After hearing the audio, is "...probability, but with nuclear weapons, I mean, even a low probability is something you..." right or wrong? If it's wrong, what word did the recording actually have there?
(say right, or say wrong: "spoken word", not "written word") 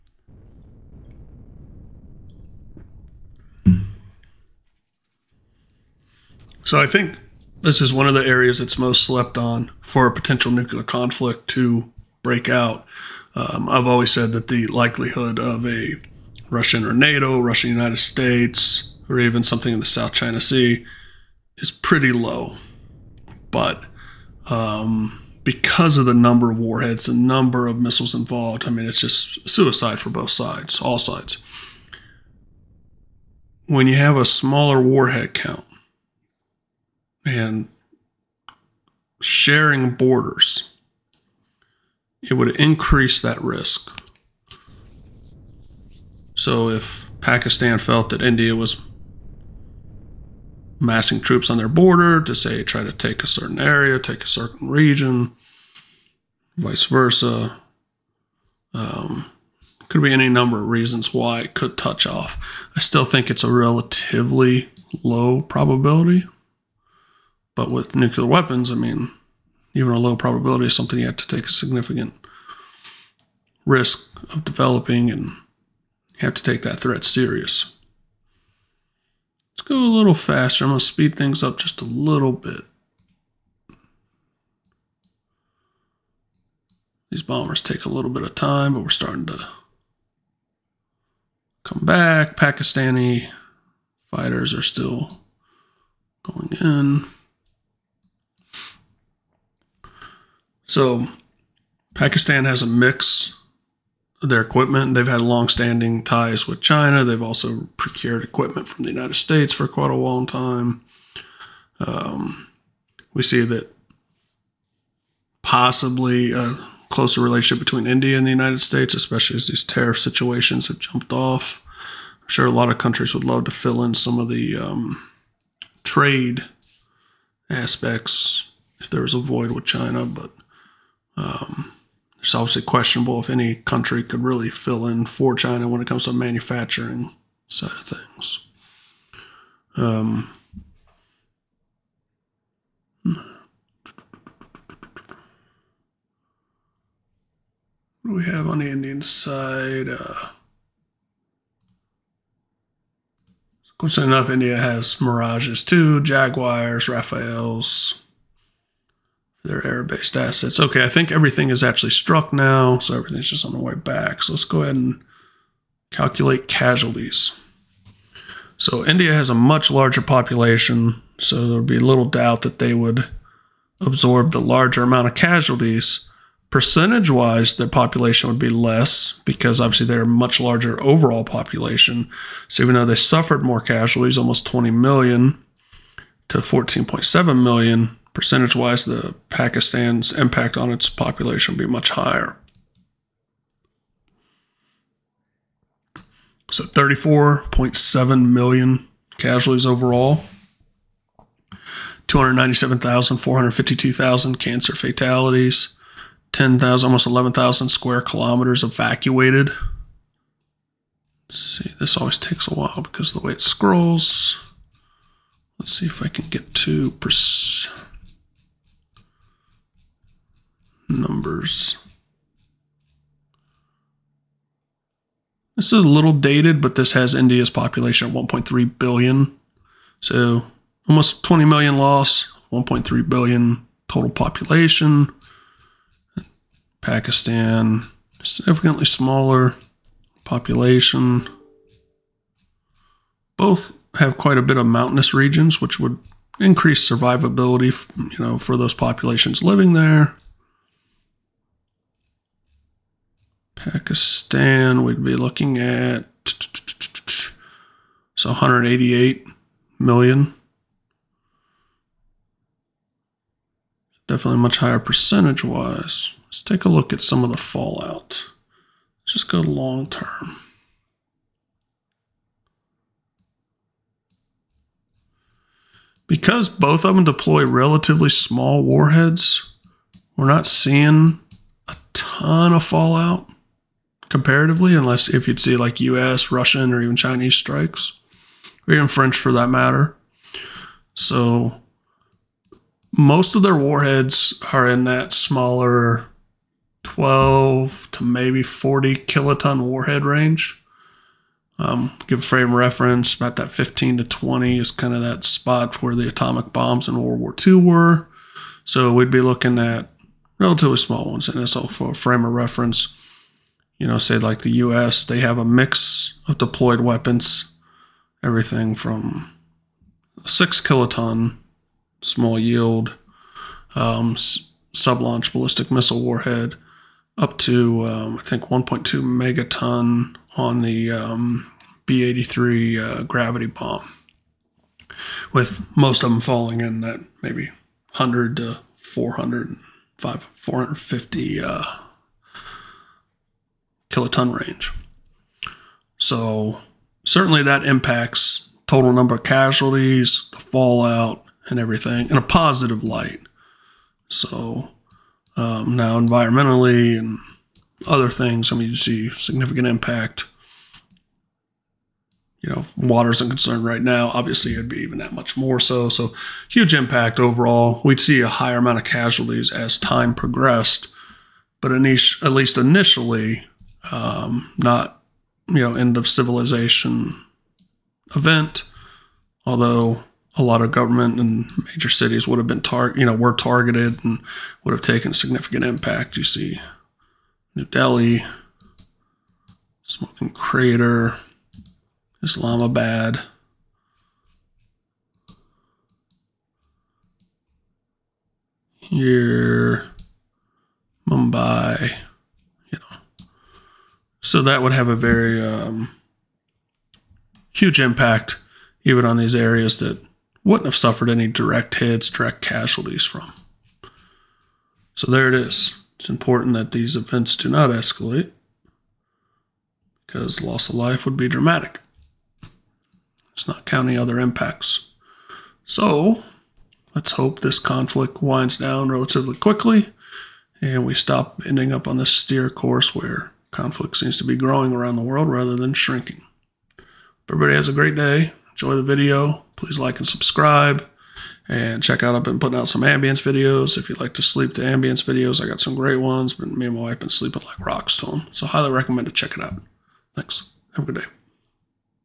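right.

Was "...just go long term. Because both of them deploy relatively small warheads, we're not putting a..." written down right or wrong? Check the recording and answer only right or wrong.
wrong.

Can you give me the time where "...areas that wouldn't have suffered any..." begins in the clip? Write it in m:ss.
6:49.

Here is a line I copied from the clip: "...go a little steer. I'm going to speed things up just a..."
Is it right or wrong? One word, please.
wrong.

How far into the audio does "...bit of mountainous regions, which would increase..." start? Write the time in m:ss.
4:04.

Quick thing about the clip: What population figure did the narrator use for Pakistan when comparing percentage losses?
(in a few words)
188 million.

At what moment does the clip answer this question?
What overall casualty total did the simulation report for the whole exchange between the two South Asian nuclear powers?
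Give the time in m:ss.
3:16.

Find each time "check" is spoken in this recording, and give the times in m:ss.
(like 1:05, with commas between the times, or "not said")
7:21, 7:29.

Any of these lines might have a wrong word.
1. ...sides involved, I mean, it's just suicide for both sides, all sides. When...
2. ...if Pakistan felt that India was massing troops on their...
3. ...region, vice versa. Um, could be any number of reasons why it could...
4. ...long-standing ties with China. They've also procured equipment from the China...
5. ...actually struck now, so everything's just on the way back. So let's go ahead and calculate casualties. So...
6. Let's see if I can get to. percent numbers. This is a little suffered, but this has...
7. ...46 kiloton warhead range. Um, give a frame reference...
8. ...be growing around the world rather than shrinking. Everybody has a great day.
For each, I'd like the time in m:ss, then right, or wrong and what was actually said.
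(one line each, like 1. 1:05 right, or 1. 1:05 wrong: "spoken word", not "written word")
1. 0:27 wrong: "missiles", not "sides"
2. 0:46 right
3. 0:54 right
4. 1:45 wrong: "United", not "China"
5. 2:41 right
6. 3:35 wrong: "dated", not "suffered"
7. 4:58 wrong: "40", not "46"
8. 7:14 right.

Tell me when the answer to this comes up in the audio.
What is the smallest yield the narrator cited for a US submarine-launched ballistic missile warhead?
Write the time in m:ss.
5:20.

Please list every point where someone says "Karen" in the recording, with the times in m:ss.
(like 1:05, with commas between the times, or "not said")
not said.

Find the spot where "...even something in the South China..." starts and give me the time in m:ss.
0:19.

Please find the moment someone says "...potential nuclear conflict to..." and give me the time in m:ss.
0:10.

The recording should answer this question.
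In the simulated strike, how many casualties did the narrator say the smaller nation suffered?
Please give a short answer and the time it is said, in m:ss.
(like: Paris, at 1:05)
14.7 million, at 3:06.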